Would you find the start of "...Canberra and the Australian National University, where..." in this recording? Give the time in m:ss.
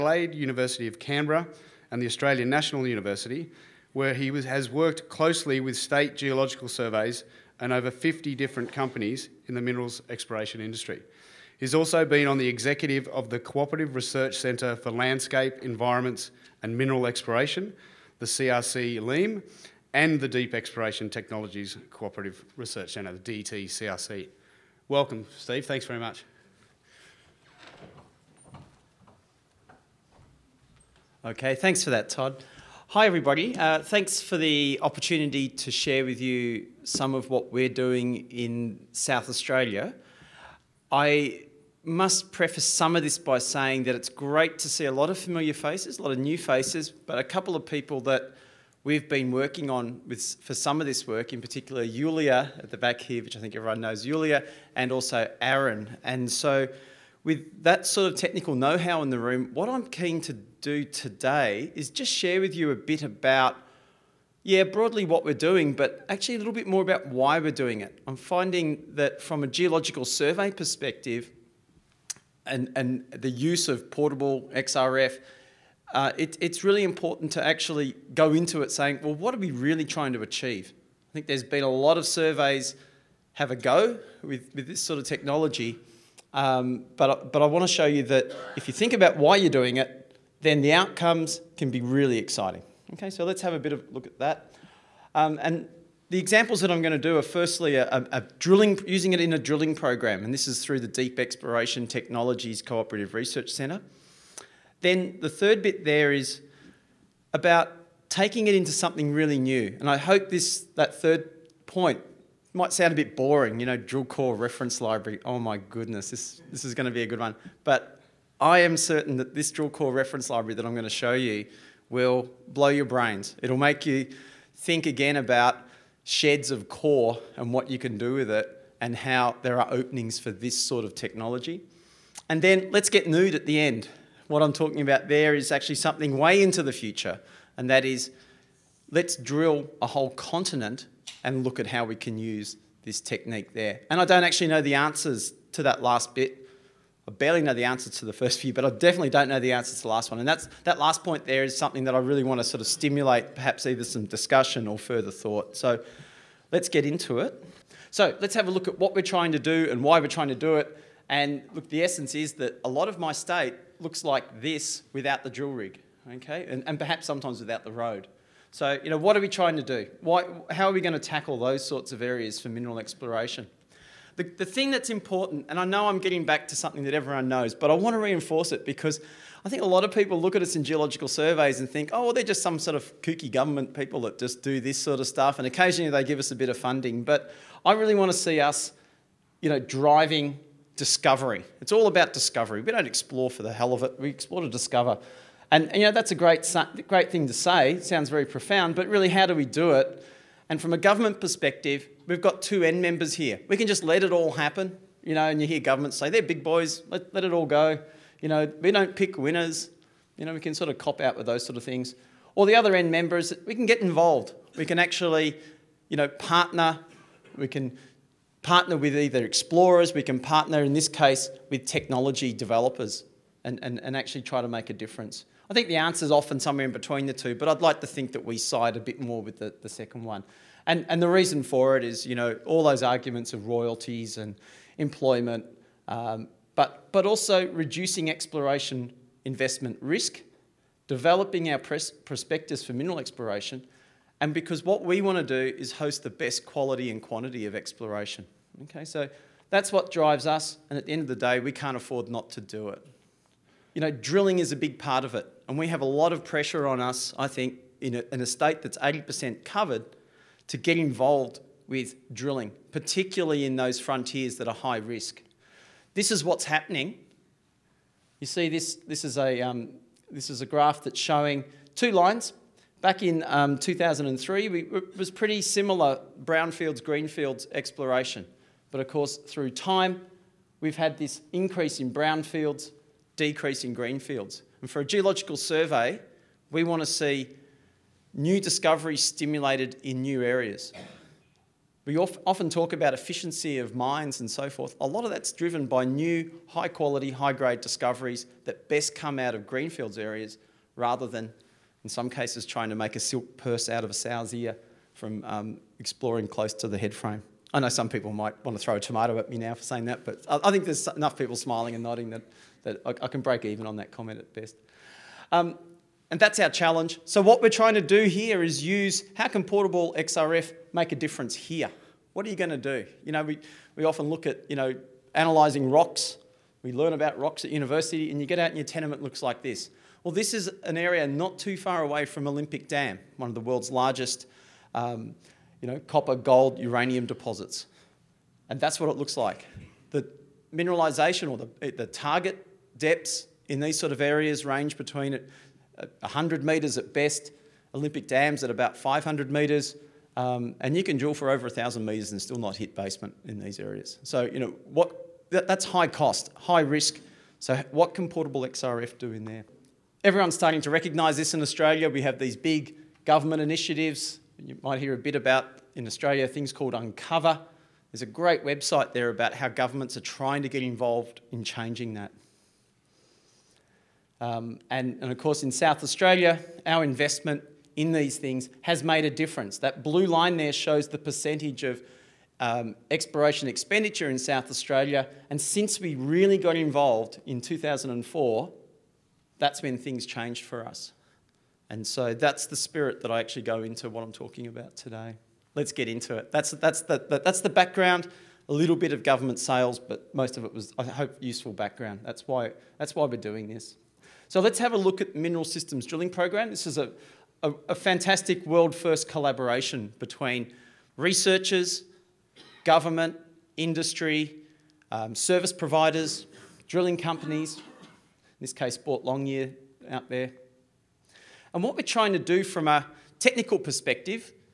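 0:00.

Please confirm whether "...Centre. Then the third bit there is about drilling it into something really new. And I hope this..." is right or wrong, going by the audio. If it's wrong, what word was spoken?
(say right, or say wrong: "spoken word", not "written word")
wrong: "taking", not "drilling".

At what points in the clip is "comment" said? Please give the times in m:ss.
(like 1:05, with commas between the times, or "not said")
5:13.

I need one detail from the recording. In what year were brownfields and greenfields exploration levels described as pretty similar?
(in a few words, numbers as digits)
2003.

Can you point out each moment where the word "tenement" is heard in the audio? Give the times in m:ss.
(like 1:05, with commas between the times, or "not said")
5:28.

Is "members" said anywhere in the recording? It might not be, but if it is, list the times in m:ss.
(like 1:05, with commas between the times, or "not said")
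3:22, 3:32.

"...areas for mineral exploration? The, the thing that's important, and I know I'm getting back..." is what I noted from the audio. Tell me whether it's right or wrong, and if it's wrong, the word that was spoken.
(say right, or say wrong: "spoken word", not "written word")
right.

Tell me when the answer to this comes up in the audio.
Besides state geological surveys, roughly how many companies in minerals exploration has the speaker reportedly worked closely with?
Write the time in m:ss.
0:07.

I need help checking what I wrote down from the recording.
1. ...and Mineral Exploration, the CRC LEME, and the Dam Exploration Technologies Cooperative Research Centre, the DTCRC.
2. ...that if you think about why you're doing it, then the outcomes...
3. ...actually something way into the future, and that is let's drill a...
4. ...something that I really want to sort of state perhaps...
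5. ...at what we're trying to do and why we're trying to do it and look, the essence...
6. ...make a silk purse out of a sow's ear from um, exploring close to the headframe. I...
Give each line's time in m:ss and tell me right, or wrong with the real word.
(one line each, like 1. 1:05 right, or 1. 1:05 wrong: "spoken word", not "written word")
1. 0:16 wrong: "Deep", not "Dam"
2. 1:28 right
3. 2:15 right
4. 2:31 wrong: "stimulate", not "state"
5. 2:38 right
6. 5:02 right.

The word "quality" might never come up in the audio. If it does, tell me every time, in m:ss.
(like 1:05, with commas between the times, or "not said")
4:06, 4:56.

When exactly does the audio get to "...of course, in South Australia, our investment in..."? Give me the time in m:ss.
6:15.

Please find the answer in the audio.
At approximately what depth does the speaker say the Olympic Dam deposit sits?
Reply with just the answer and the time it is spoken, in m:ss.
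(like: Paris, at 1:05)
500 metres, at 5:48.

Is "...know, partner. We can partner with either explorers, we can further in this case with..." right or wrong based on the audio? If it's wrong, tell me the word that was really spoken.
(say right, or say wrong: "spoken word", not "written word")
wrong: "partner", not "further".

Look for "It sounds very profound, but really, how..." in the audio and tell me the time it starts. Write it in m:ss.
3:17.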